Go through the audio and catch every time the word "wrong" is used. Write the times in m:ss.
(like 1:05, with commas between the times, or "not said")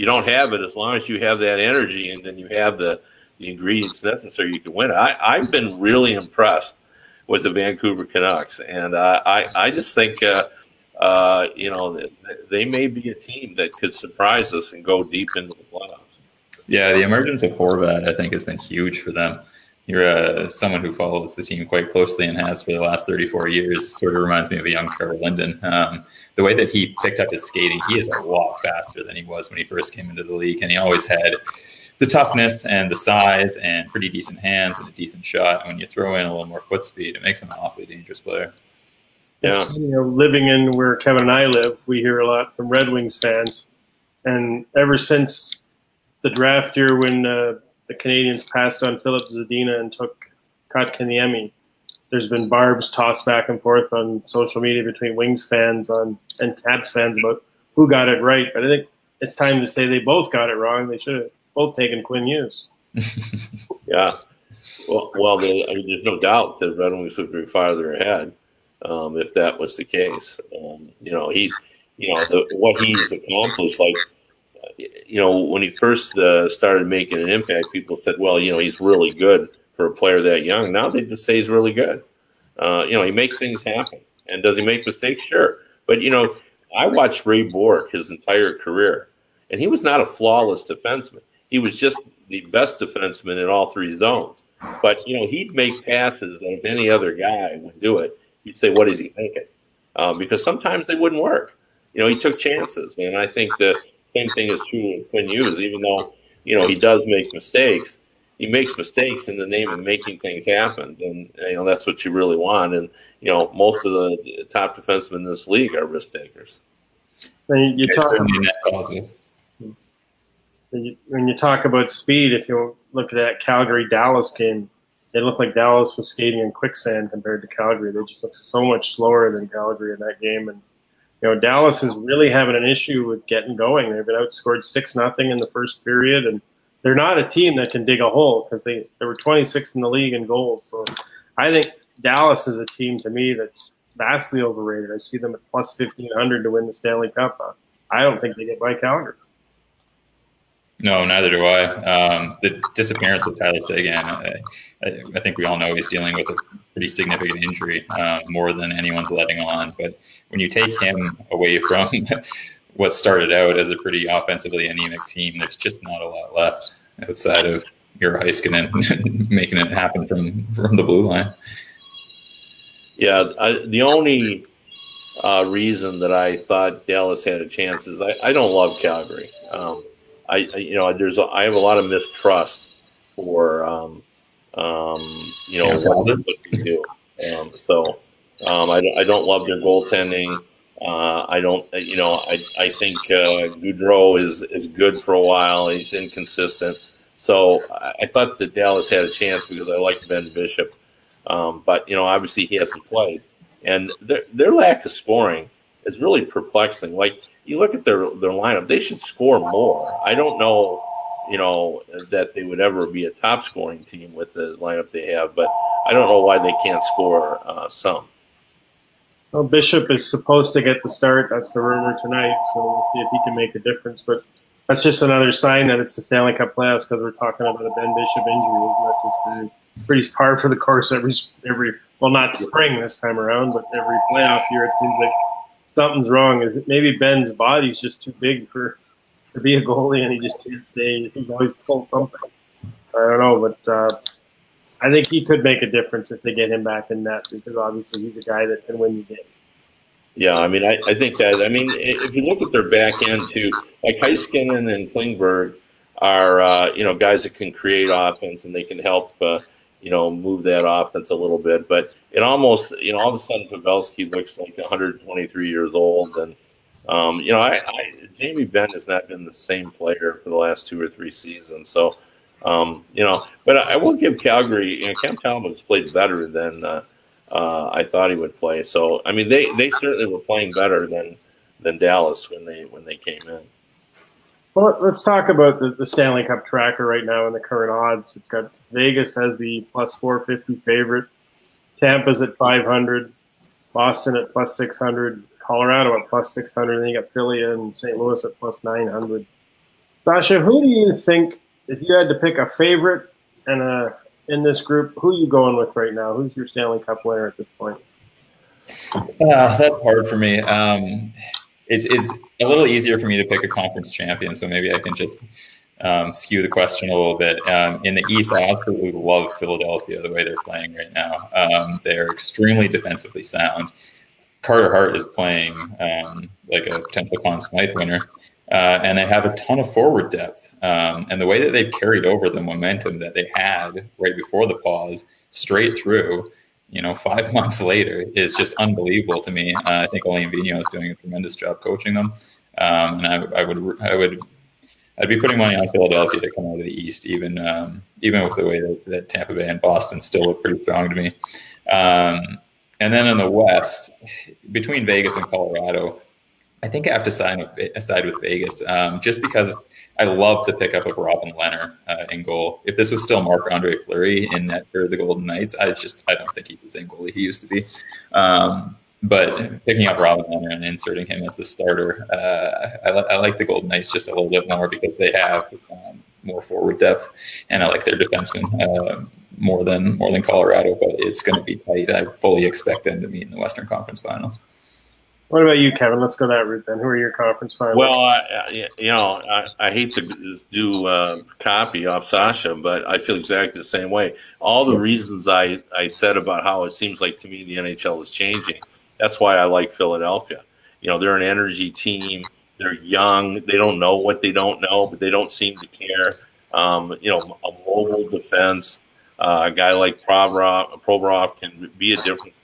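1:00, 3:56.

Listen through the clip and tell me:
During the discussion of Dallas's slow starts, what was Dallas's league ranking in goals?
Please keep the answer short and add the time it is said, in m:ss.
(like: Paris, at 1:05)
26, at 2:19.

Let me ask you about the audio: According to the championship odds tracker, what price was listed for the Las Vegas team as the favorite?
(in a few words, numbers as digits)
+450.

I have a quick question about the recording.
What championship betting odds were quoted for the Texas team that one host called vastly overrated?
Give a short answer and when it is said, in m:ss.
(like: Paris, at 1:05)
+1500, at 2:25.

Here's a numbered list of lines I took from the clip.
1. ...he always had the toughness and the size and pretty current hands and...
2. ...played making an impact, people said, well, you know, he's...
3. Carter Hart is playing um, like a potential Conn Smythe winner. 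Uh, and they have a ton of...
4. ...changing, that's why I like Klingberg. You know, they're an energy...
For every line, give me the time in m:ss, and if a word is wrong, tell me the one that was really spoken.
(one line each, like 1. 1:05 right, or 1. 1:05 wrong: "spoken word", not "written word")
1. 0:30 wrong: "decent", not "current"
2. 1:16 wrong: "started", not "played"
3. 5:24 right
4. 6:38 wrong: "Philadelphia", not "Klingberg".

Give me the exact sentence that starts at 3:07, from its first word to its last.
Um, so um, I, I don't love their goaltending.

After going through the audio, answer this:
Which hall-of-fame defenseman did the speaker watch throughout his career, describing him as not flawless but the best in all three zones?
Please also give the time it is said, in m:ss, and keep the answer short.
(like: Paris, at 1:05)
Ray Bourque, at 1:27.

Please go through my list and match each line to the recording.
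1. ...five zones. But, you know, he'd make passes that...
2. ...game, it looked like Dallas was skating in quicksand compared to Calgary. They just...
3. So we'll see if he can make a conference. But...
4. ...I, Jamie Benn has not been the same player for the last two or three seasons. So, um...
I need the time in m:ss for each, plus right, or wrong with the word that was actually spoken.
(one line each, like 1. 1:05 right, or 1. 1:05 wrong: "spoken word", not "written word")
1. 1:33 wrong: "three", not "five"
2. 2:04 right
3. 3:42 wrong: "difference", not "conference"
4. 4:27 right.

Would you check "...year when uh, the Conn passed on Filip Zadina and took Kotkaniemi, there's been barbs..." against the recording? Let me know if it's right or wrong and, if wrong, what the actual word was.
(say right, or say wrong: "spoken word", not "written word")
wrong: "Canadiens", not "Conn".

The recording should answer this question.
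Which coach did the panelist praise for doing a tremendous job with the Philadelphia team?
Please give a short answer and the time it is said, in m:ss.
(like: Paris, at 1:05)
Alain Vigneault, at 5:40.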